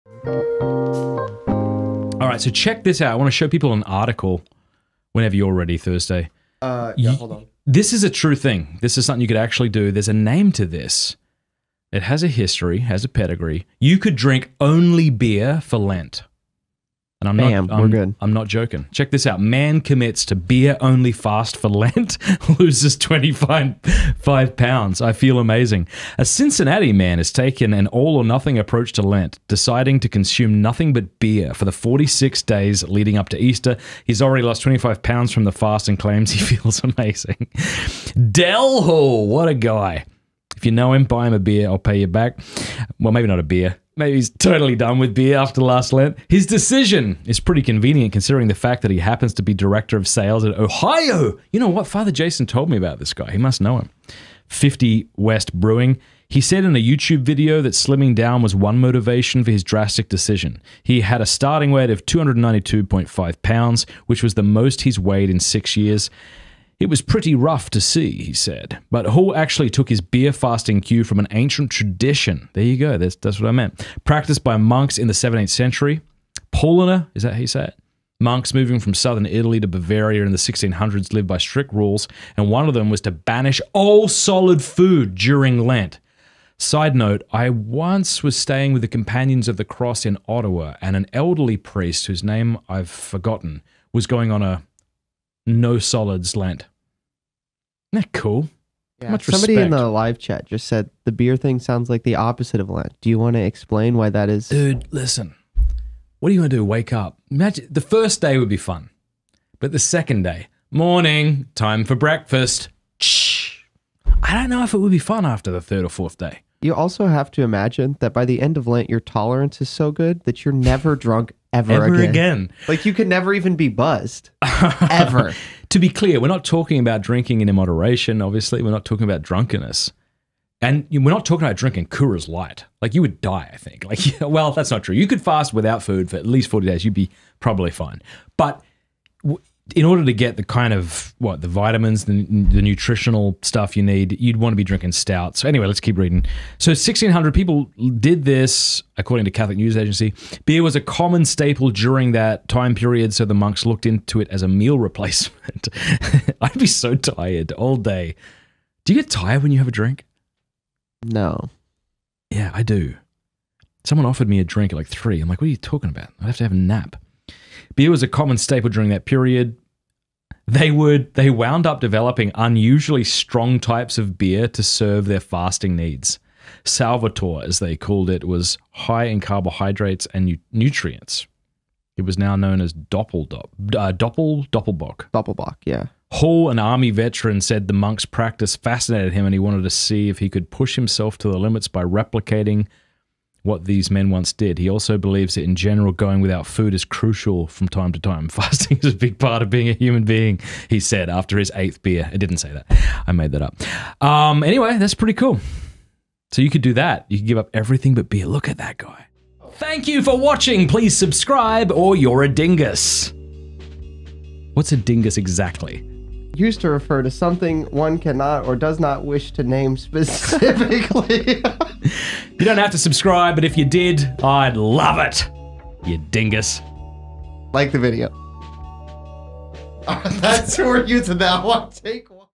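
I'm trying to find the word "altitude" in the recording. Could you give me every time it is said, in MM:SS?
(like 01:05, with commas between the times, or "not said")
not said.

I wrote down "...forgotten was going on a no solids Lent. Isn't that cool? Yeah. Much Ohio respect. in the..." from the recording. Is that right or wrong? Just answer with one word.
wrong.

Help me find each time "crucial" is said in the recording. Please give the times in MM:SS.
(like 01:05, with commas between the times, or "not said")
03:16.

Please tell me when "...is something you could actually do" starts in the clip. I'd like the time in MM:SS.
00:08.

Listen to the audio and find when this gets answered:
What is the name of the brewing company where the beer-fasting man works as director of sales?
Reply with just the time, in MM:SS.
00:54.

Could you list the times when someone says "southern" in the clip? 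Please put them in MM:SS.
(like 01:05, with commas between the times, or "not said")
01:18.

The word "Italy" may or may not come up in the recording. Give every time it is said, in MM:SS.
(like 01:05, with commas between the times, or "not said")
01:19.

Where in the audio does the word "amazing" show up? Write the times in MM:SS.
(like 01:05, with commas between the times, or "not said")
00:25, 00:36.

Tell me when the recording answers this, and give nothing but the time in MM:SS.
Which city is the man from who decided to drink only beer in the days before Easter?
00:26.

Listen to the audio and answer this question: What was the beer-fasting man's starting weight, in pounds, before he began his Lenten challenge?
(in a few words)
292.5.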